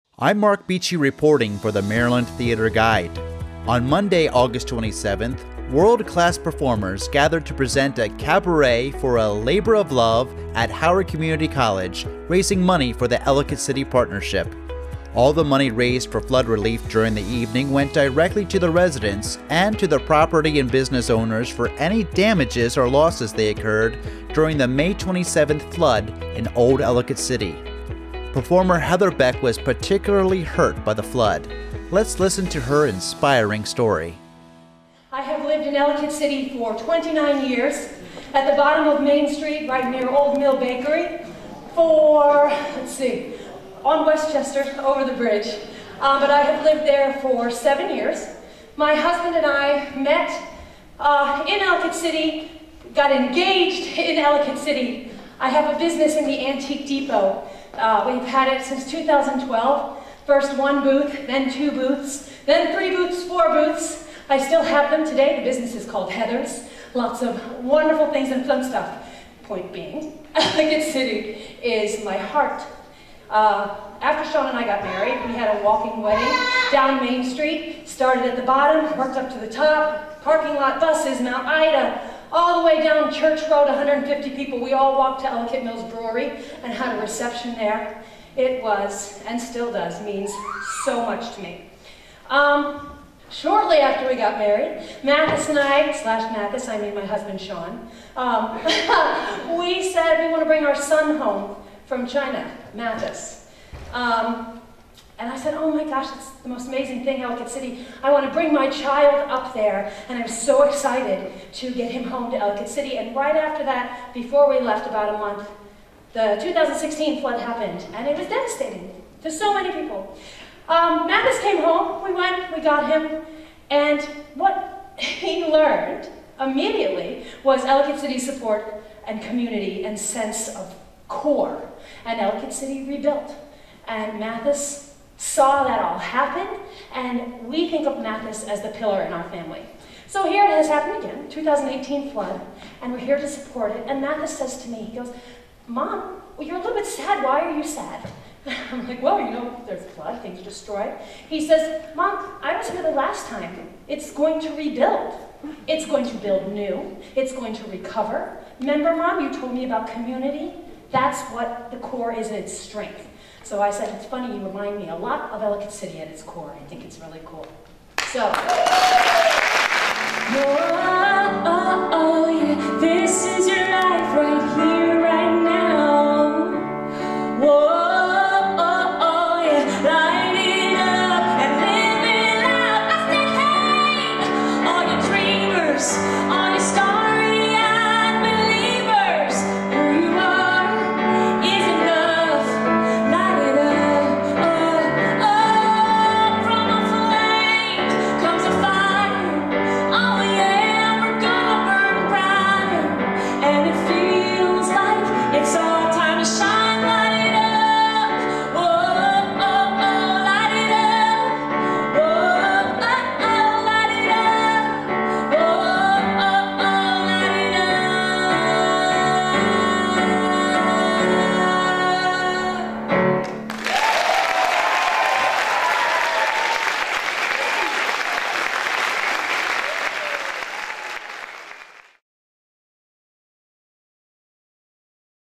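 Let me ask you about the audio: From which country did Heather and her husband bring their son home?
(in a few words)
China.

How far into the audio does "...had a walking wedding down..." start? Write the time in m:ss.
1:15.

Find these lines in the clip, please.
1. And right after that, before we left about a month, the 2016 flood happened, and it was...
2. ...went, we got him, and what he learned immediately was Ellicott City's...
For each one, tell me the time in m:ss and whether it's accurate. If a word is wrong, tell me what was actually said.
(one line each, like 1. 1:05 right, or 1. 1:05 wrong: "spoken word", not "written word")
1. 1:52 right
2. 2:02 right.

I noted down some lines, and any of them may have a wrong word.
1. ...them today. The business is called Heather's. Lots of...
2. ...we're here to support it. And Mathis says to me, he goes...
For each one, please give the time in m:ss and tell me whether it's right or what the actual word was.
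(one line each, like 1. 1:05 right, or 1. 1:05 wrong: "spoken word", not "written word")
1. 1:04 right
2. 2:22 right.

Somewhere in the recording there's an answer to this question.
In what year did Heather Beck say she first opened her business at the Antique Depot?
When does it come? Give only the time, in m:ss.
0:58.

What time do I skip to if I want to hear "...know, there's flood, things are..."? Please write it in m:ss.
2:29.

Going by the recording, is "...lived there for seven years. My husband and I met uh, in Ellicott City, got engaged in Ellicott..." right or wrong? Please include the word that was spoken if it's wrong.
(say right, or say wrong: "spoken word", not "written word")
right.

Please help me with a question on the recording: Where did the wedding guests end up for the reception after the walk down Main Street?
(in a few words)
Ellicott Mills Brewery.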